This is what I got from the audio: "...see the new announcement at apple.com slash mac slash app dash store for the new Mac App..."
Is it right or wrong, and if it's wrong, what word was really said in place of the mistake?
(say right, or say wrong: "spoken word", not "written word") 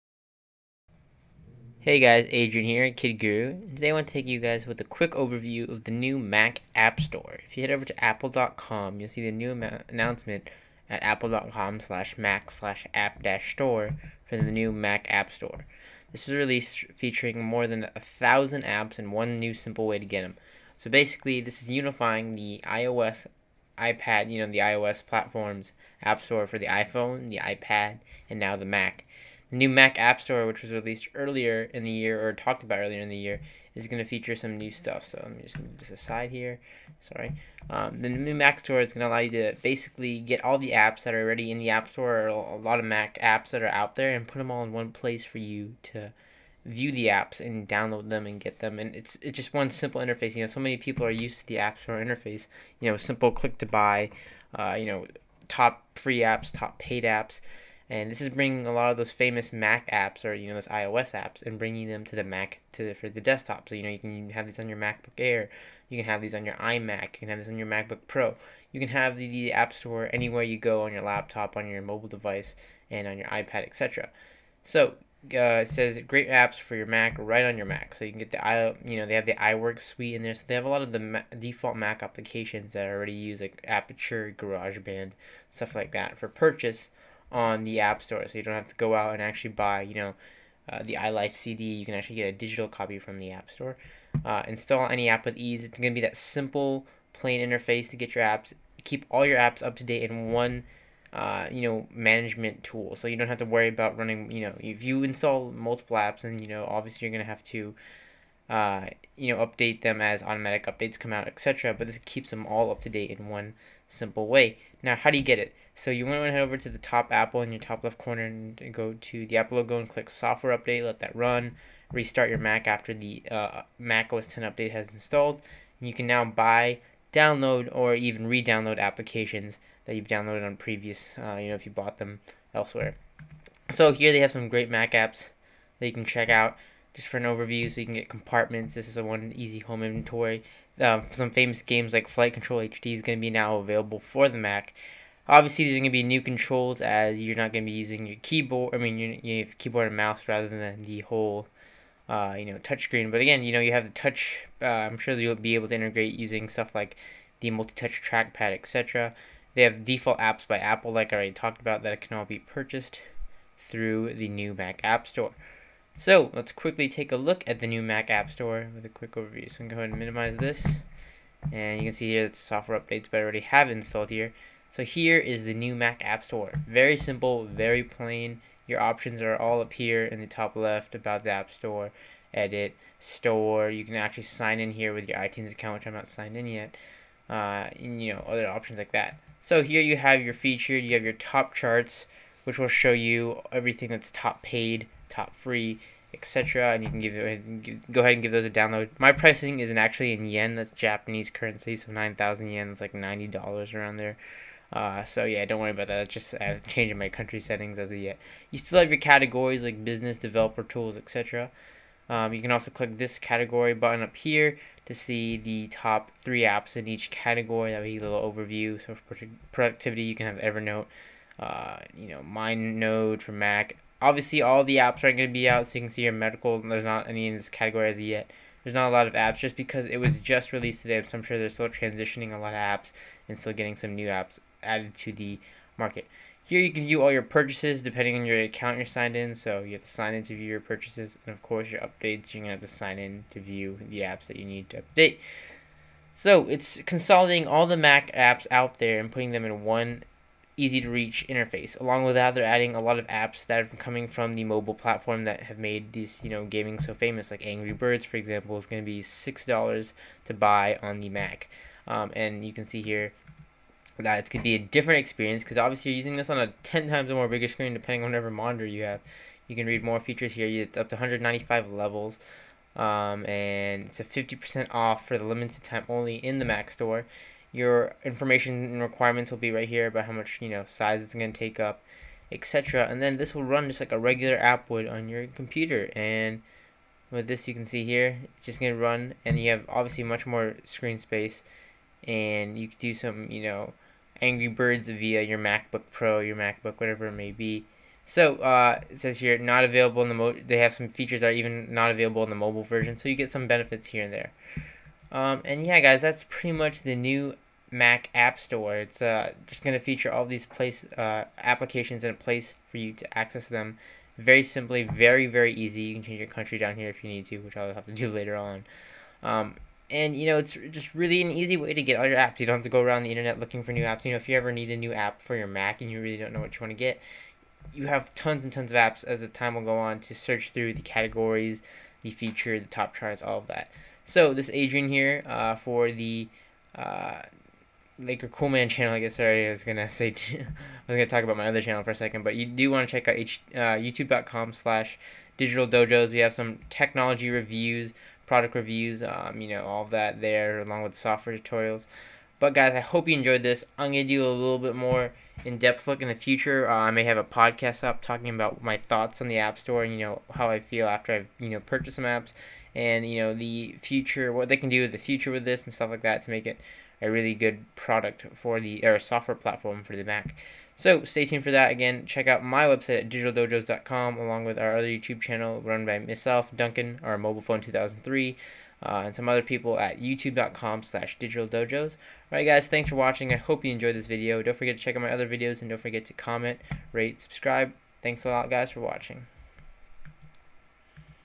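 right.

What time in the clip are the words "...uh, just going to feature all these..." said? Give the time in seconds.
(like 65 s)
309 s.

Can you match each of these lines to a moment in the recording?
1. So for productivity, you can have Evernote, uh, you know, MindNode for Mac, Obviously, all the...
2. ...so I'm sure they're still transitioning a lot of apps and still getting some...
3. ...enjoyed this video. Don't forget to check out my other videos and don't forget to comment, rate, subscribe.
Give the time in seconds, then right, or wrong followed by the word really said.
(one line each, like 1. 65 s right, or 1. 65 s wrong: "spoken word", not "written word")
1. 218 s right
2. 231 s right
3. 383 s right.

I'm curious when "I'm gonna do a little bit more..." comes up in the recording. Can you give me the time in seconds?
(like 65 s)
353 s.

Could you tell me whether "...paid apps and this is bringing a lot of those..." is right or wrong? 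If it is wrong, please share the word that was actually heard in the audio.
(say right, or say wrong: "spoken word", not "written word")
right.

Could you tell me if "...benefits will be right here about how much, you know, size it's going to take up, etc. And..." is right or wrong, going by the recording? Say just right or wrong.
wrong.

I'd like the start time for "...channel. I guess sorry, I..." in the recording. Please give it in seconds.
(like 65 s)
338 s.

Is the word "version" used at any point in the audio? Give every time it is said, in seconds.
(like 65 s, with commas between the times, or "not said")
302 s.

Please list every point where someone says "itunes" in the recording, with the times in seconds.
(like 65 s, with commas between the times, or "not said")
185 s.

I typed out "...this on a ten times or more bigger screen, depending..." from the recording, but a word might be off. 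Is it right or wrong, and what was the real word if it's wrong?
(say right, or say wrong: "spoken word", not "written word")
right.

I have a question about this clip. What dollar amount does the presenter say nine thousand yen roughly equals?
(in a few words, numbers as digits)
$90.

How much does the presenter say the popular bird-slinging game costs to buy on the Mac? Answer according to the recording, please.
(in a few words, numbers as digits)
$6.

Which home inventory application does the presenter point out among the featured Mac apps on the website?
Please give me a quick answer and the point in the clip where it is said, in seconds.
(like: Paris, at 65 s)
Compartments, at 138 s.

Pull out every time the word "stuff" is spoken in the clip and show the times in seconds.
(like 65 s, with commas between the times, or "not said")
34 s, 85 s, 156 s, 365 s.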